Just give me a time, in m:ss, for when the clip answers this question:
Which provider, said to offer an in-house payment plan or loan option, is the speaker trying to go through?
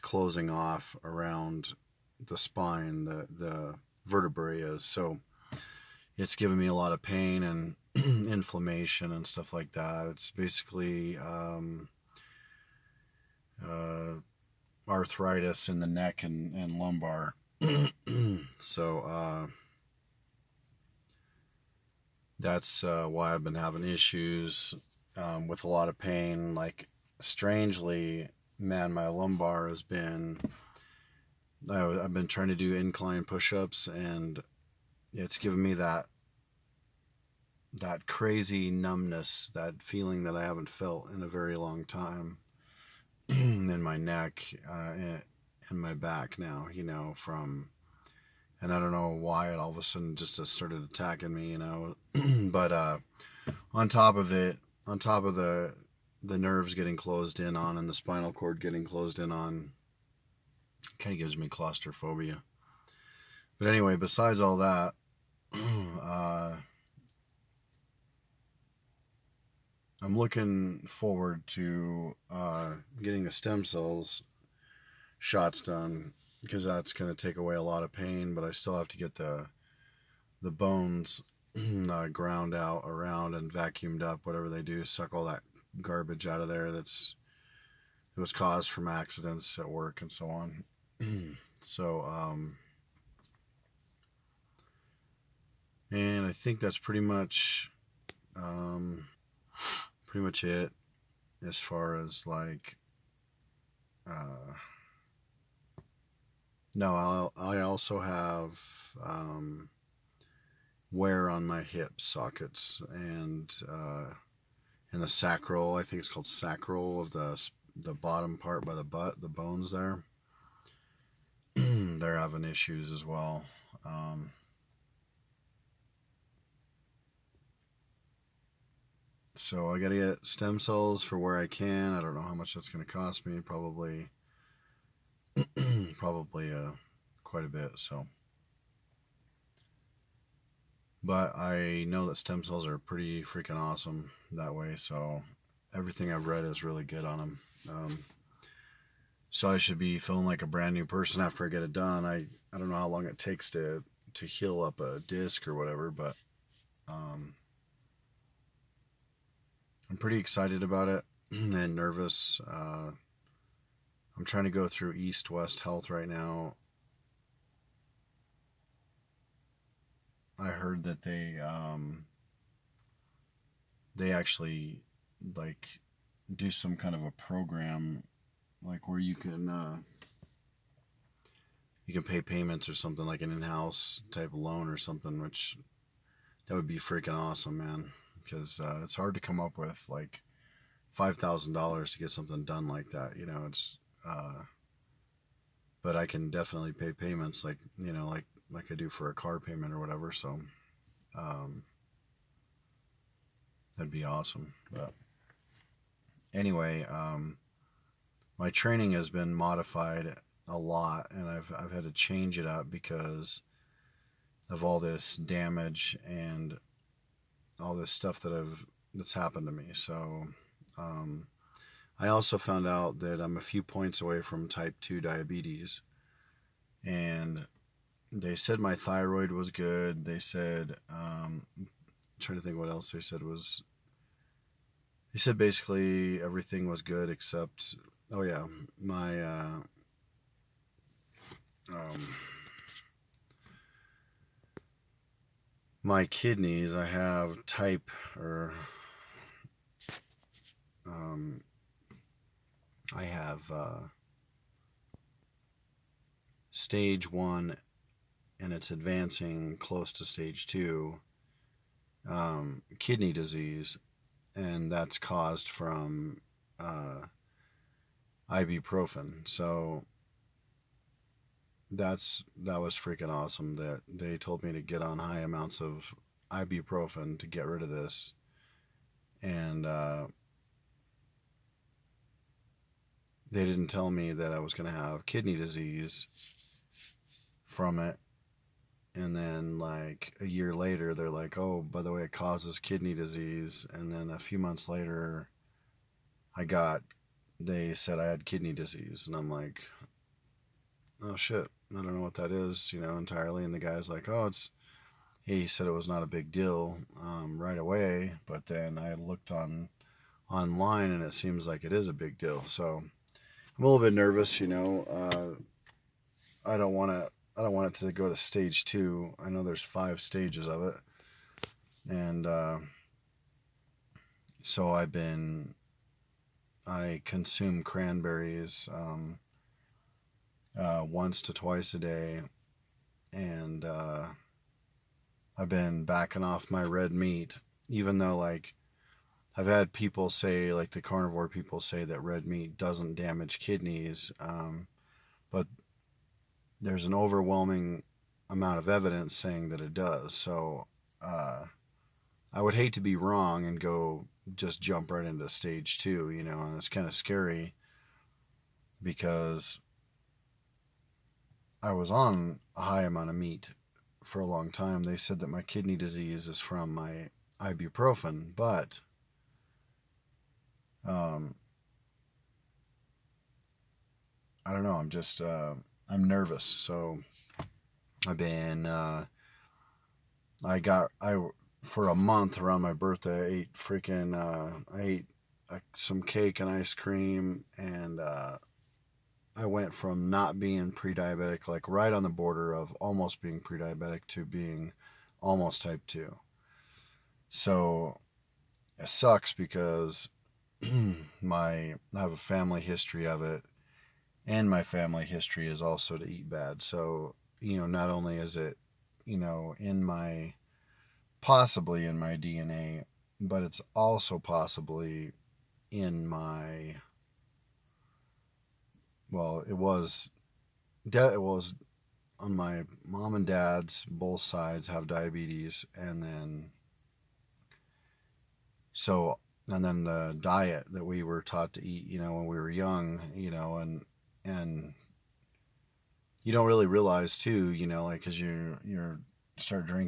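2:44.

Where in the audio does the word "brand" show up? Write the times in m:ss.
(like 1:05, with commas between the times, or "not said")
2:30.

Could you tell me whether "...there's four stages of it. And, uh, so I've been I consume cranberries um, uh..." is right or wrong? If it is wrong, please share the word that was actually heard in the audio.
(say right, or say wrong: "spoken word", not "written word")
wrong: "five", not "four".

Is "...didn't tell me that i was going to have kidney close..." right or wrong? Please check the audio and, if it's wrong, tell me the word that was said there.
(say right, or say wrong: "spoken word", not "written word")
wrong: "disease", not "close".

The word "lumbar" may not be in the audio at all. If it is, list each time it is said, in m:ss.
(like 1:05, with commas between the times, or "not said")
0:16, 0:29.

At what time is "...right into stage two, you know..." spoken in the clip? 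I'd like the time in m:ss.
5:54.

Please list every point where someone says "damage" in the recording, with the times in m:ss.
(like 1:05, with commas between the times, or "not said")
3:35, 5:42.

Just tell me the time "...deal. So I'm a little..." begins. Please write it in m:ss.
5:12.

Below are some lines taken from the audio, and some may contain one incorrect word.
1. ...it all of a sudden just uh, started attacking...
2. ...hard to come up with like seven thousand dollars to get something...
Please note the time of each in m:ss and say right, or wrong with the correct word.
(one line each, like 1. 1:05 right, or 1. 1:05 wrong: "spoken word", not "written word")
1. 0:49 right
2. 3:08 wrong: "five", not "seven".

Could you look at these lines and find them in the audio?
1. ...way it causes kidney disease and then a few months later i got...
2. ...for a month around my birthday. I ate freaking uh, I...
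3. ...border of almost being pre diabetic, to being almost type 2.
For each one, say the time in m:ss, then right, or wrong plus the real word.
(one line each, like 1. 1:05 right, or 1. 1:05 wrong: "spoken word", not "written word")
1. 4:51 right
2. 6:21 right
3. 6:32 right.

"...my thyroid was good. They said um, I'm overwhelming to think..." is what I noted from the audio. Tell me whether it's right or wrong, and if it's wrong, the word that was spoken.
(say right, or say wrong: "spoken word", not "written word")
wrong: "trying", not "overwhelming".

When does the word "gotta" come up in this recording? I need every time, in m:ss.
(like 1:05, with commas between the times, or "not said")
2:09.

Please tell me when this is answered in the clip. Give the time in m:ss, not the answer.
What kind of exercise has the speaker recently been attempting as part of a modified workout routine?
0:32.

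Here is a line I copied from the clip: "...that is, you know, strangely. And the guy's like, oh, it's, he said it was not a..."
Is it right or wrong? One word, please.
wrong.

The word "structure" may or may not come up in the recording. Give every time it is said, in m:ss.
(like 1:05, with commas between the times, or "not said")
not said.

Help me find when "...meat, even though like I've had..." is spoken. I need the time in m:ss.
5:36.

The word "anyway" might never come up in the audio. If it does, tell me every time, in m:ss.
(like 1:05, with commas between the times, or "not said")
1:03, 3:26.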